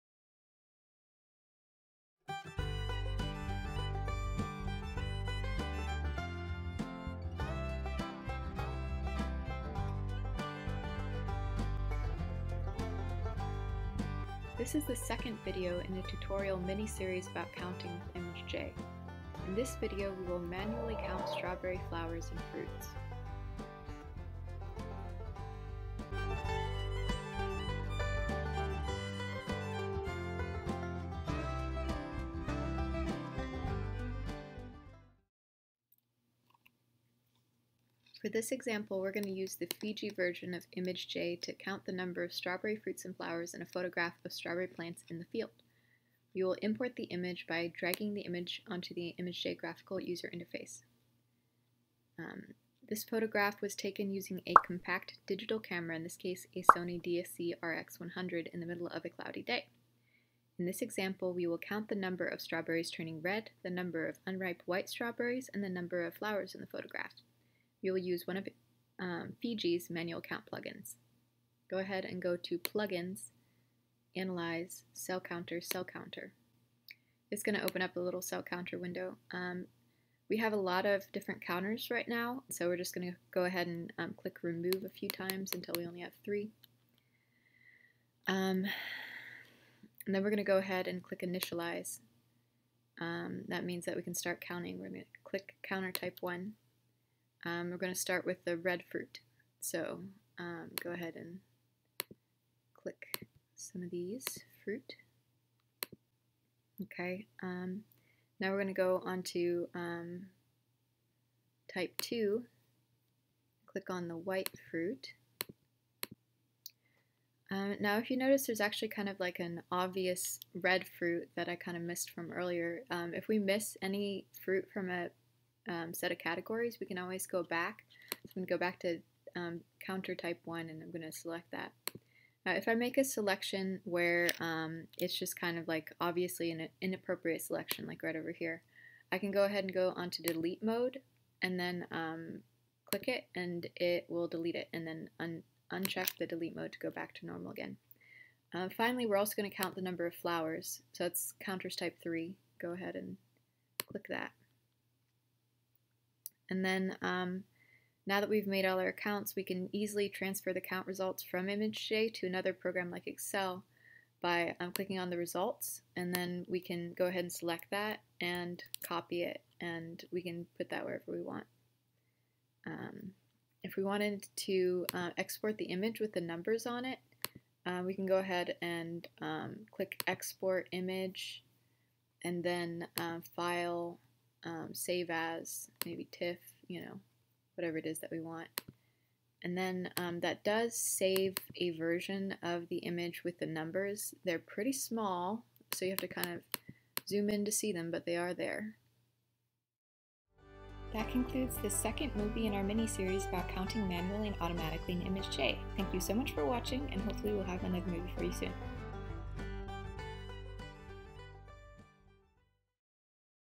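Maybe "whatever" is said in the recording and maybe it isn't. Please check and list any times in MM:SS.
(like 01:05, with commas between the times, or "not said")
03:07.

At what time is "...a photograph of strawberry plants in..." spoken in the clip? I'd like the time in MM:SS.
00:43.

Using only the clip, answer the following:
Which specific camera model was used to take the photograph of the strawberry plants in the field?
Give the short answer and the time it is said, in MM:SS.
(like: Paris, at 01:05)
Sony DSC RX100, at 00:56.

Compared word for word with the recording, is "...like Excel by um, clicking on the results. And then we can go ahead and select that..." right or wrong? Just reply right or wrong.
right.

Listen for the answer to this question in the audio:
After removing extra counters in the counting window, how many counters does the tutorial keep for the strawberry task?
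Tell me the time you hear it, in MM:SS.
01:26.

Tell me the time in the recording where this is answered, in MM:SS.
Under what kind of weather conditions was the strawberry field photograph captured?
00:59.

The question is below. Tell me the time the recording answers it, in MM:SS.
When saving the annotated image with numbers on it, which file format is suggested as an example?
03:06.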